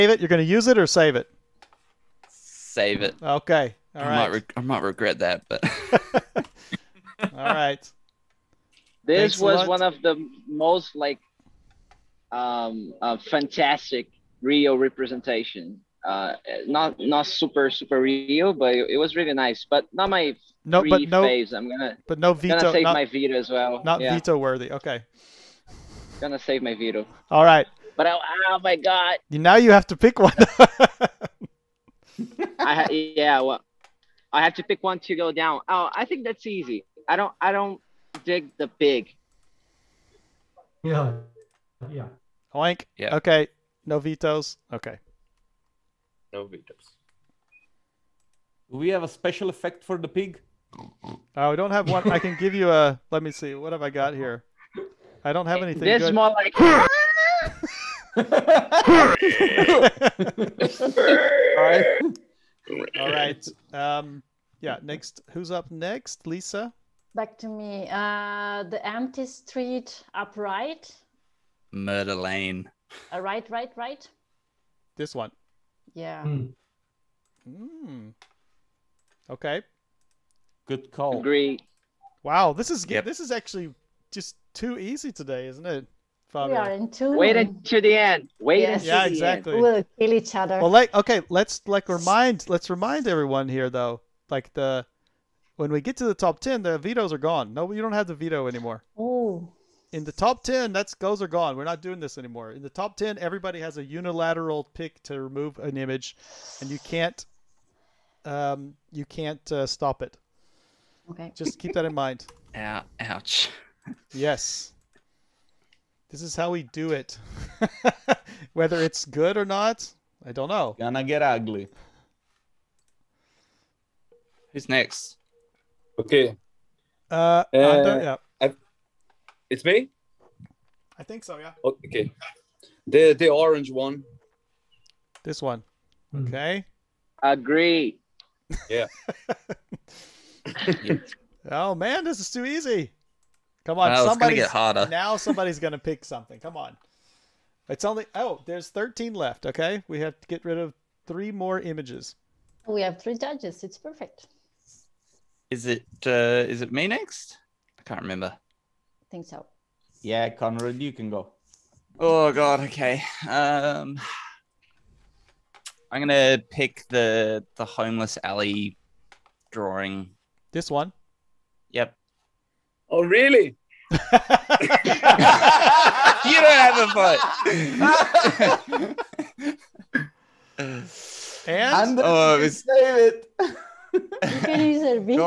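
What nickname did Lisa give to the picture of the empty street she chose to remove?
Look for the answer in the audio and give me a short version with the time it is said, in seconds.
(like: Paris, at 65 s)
Murder Lane, at 71 s.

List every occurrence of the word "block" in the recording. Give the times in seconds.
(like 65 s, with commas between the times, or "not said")
not said.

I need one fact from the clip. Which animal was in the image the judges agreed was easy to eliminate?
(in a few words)
Pig.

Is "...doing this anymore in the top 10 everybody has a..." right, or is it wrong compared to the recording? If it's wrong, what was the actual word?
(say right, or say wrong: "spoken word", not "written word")
right.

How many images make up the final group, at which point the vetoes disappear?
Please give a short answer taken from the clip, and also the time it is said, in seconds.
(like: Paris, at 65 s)
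10, at 96 s.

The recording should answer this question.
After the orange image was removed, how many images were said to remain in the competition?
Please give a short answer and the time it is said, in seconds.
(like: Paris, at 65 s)
13, at 148 s.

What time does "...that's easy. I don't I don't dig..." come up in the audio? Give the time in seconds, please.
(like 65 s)
36 s.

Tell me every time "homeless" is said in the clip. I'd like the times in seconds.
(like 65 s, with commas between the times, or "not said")
167 s.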